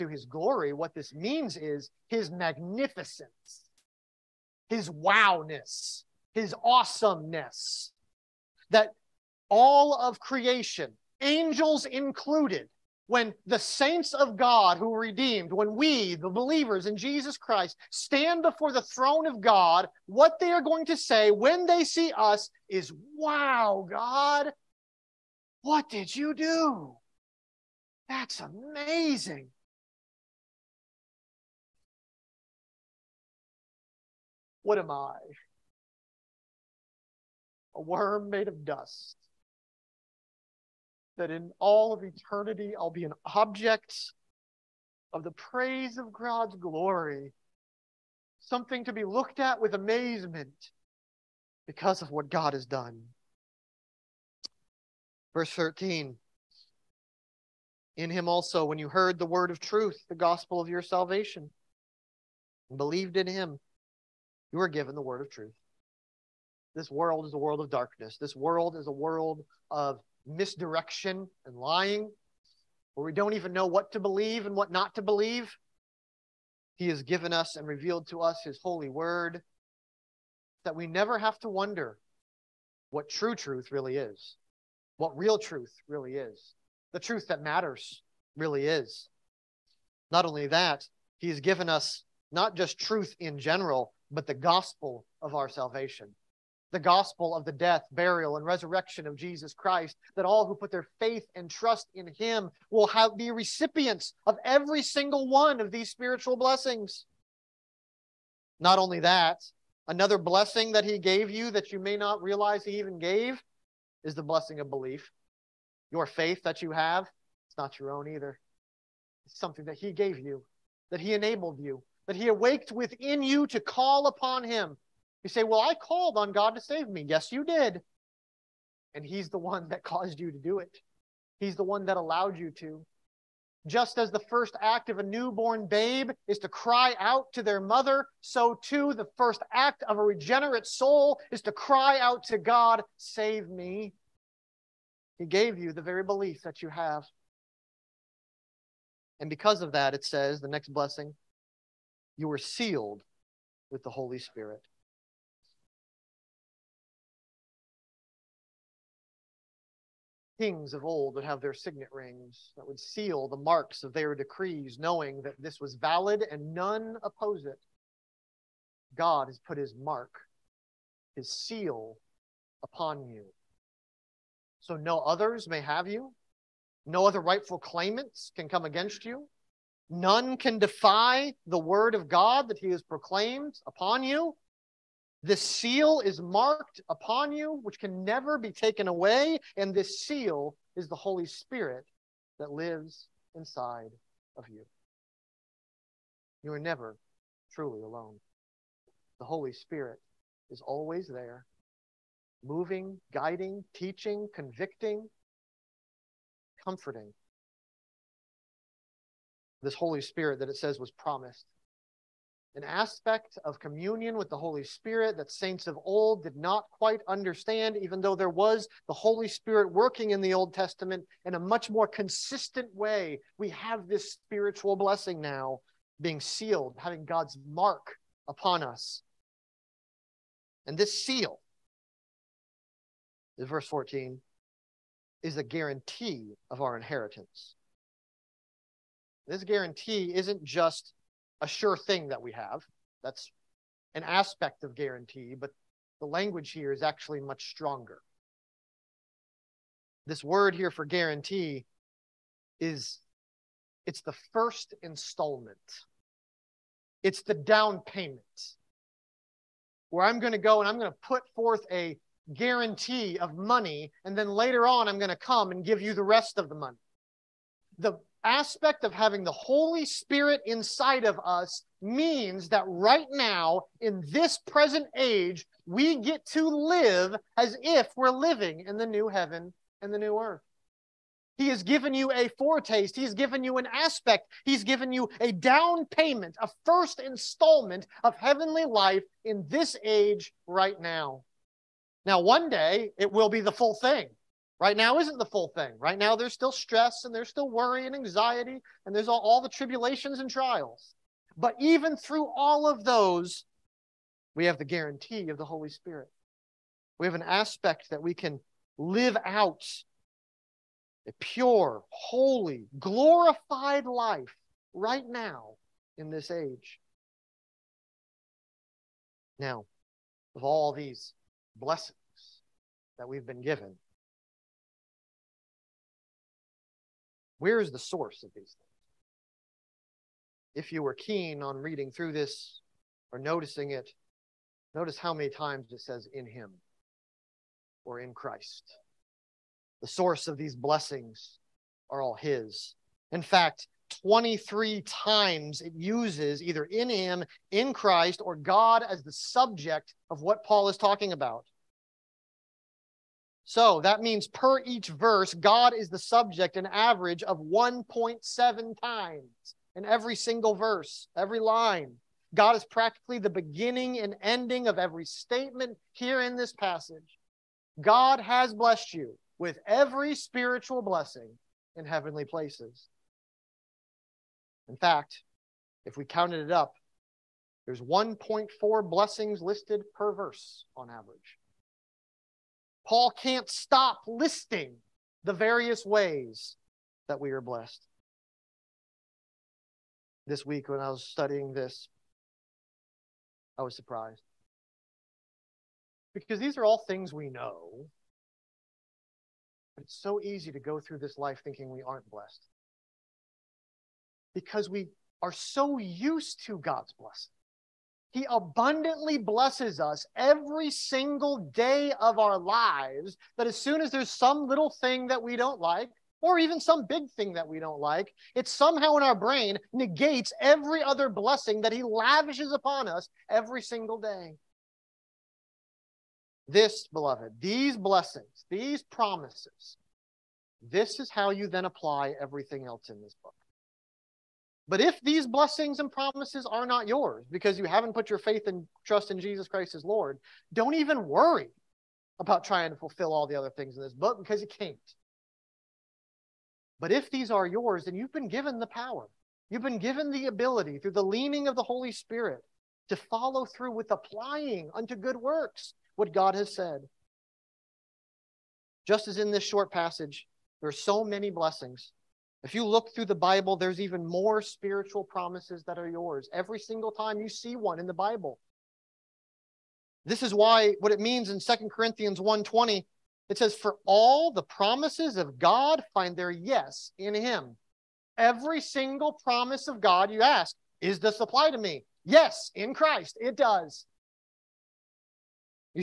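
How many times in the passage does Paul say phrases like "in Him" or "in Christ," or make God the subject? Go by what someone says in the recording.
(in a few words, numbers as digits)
23.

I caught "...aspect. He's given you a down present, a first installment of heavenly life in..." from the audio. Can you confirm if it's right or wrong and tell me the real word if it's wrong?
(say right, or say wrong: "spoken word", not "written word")
wrong: "payment", not "present".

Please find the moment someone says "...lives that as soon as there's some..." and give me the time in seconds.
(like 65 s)
412 s.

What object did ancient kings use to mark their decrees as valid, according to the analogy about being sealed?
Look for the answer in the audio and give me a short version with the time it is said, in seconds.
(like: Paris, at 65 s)
Signet rings, at 161 s.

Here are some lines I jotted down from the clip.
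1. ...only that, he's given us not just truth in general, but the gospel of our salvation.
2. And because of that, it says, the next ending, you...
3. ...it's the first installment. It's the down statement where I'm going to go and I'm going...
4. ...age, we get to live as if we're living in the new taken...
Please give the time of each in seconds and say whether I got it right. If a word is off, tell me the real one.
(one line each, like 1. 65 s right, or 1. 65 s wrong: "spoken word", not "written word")
1. 90 s right
2. 149 s wrong: "blessing", not "ending"
3. 253 s wrong: "payment", not "statement"
4. 274 s wrong: "heaven", not "taken".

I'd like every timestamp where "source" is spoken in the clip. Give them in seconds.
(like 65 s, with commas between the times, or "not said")
327 s, 339 s.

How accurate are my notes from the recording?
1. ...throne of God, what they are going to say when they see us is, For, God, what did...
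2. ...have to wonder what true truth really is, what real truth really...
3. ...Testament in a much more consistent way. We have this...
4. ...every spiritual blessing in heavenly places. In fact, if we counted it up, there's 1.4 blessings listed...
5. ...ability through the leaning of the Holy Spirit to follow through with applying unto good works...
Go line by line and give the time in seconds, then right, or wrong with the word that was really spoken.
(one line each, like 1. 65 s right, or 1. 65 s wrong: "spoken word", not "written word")
1. 18 s wrong: "Wow", not "For"
2. 81 s right
3. 220 s right
4. 369 s right
5. 450 s right.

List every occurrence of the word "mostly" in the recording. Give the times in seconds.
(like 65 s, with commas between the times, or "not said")
not said.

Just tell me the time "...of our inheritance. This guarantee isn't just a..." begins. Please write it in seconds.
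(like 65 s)
236 s.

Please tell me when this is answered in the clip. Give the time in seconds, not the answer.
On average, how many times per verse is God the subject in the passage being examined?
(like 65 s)
357 s.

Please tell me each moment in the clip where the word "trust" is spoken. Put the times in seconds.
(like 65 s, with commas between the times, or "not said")
101 s, 438 s.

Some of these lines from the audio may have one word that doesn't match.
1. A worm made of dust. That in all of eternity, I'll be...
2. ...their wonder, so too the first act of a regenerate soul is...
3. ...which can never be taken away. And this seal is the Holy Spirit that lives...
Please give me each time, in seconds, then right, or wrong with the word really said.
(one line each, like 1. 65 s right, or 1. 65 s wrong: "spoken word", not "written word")
1. 37 s right
2. 137 s wrong: "mother", not "wonder"
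3. 187 s right.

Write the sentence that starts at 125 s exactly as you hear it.
You say, Well, I called on God to save me.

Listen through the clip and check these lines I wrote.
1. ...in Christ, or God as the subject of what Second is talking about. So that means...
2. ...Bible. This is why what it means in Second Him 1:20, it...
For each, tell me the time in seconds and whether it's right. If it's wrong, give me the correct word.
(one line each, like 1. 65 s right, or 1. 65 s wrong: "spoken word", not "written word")
1. 347 s wrong: "Paul", not "Second"
2. 467 s wrong: "Corinthians", not "Him".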